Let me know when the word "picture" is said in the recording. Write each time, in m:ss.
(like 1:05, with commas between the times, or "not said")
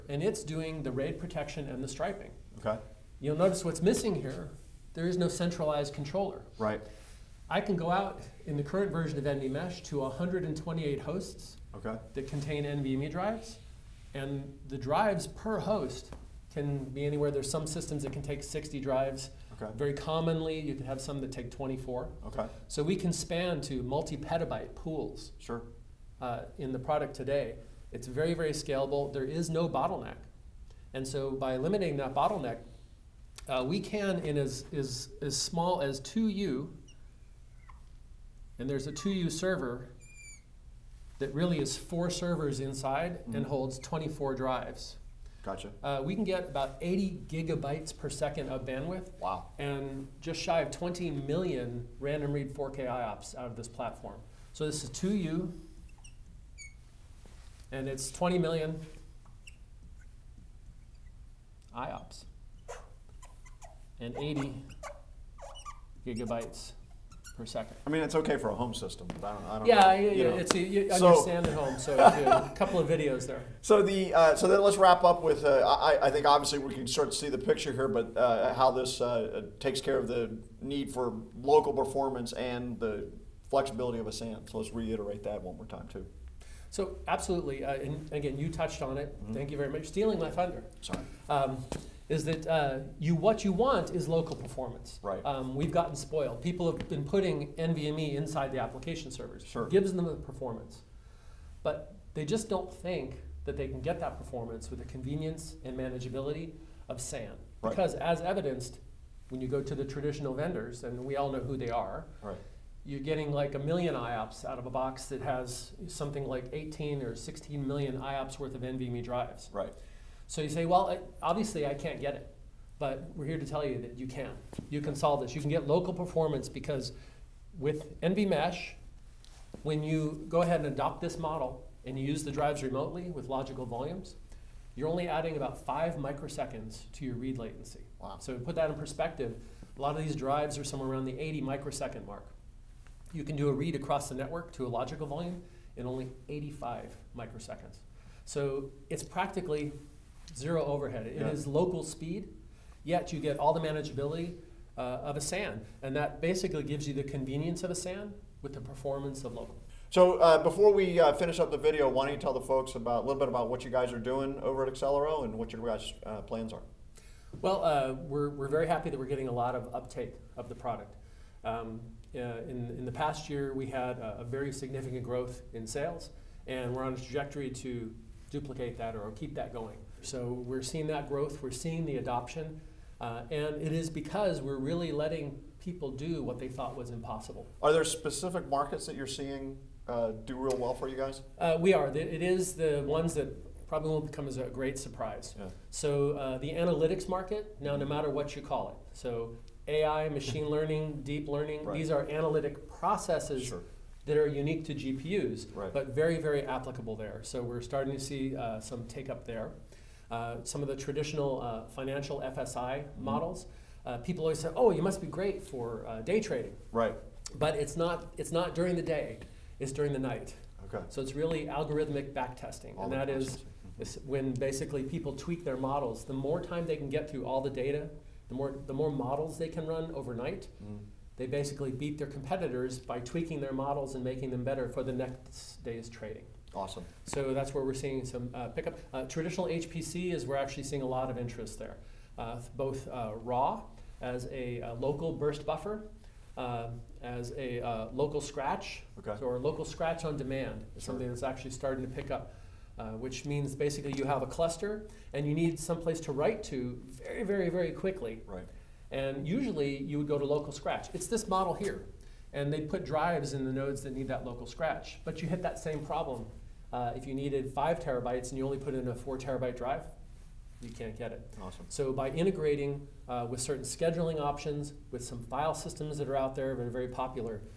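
1:17.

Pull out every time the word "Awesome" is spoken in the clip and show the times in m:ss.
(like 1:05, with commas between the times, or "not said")
3:56, 4:31.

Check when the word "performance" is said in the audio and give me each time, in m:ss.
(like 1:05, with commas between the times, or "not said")
1:21, 1:34, 1:40, 1:44, 2:05, 2:38.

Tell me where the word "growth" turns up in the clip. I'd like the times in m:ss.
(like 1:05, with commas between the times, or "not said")
2:55, 3:01.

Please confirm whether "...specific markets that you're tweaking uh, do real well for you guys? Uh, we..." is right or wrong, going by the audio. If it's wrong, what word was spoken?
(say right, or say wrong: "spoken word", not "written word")
wrong: "seeing", not "tweaking".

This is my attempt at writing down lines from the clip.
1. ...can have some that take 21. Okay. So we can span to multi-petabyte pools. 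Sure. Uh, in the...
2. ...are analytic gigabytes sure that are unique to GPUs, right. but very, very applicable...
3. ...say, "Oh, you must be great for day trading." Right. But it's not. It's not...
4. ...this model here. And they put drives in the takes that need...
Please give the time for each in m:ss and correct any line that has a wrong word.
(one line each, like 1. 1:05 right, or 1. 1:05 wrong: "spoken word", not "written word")
1. 0:20 wrong: "24", not "21"
2. 3:21 wrong: "processes", not "gigabytes"
3. 3:34 right
4. 4:21 wrong: "nodes", not "takes".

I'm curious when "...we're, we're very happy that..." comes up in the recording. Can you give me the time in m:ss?
2:48.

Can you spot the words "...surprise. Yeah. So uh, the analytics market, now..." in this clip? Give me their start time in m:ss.
3:14.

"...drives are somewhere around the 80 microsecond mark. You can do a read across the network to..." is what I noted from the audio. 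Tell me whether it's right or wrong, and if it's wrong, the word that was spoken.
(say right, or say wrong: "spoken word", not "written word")
right.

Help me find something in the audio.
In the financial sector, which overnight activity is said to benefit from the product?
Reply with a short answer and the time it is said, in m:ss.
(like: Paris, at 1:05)
algorithmic backtesting, at 3:41.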